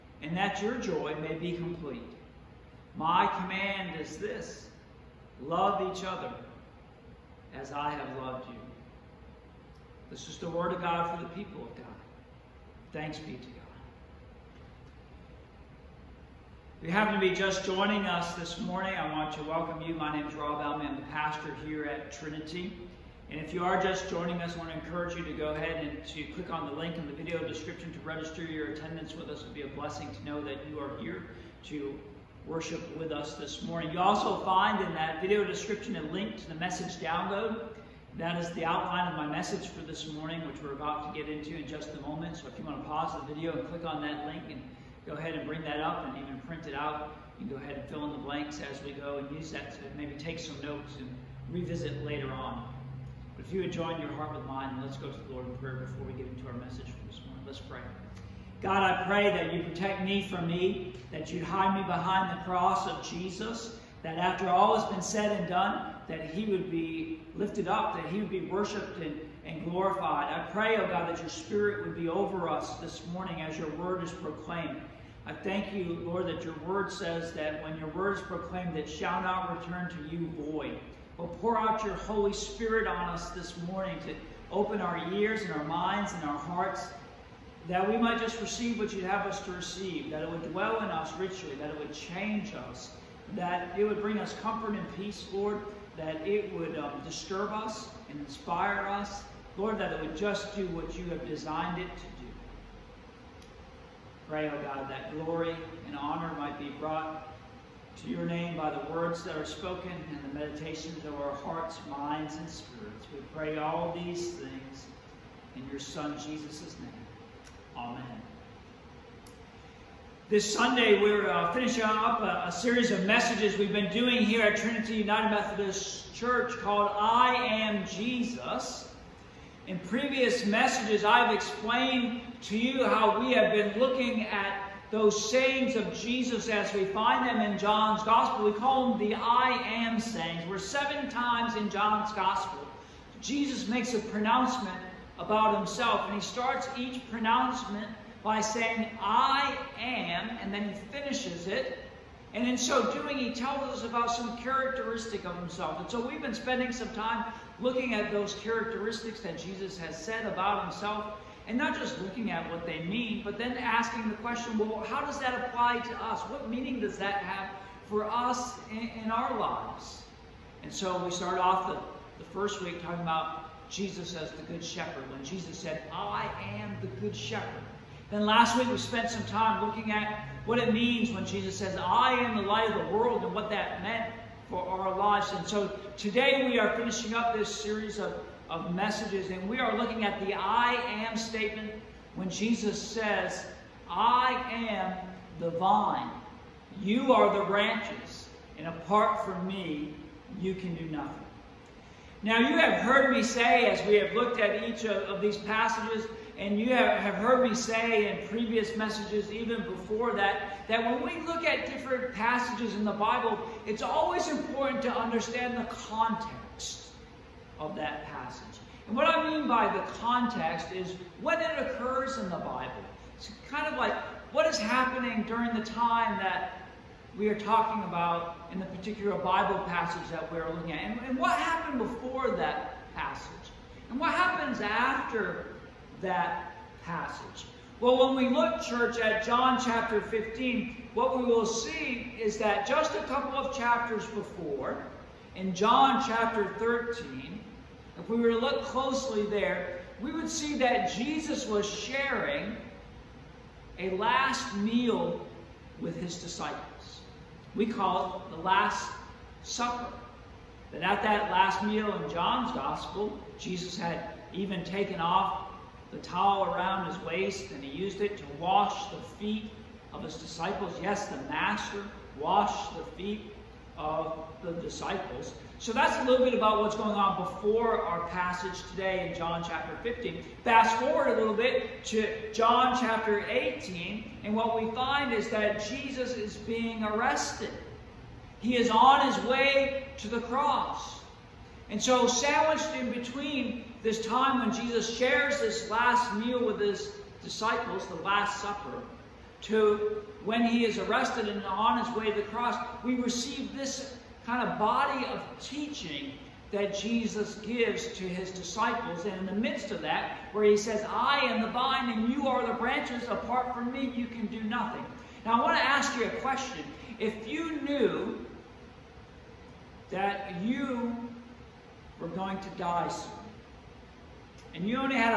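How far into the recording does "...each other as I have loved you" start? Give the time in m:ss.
0:05.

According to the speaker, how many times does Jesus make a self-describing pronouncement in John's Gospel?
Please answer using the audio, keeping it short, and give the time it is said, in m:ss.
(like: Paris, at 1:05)
7, at 2:20.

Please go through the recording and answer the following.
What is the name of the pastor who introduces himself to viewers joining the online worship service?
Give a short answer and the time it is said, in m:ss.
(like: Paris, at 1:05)
Robb Elman, at 0:20.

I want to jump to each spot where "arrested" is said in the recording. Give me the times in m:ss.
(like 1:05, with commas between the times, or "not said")
4:46, 5:00.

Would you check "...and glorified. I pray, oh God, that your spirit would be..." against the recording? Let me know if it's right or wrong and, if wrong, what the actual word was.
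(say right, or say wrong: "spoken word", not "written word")
right.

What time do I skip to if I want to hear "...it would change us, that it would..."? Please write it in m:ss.
1:31.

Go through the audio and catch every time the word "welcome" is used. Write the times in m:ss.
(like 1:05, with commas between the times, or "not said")
0:19.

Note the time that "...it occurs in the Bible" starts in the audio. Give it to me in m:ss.
3:41.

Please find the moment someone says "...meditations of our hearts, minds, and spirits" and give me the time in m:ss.
1:50.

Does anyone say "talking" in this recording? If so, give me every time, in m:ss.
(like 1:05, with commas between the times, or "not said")
2:52, 3:47.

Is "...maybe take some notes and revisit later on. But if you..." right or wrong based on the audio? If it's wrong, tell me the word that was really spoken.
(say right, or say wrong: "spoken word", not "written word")
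right.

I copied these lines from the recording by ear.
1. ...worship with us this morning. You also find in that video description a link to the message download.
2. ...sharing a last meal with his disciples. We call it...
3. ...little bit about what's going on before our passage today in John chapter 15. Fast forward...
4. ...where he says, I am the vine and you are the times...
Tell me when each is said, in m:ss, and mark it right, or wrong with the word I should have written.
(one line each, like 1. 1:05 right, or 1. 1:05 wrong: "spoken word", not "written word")
1. 0:32 right
2. 4:11 right
3. 4:36 right
4. 5:10 wrong: "branches", not "times".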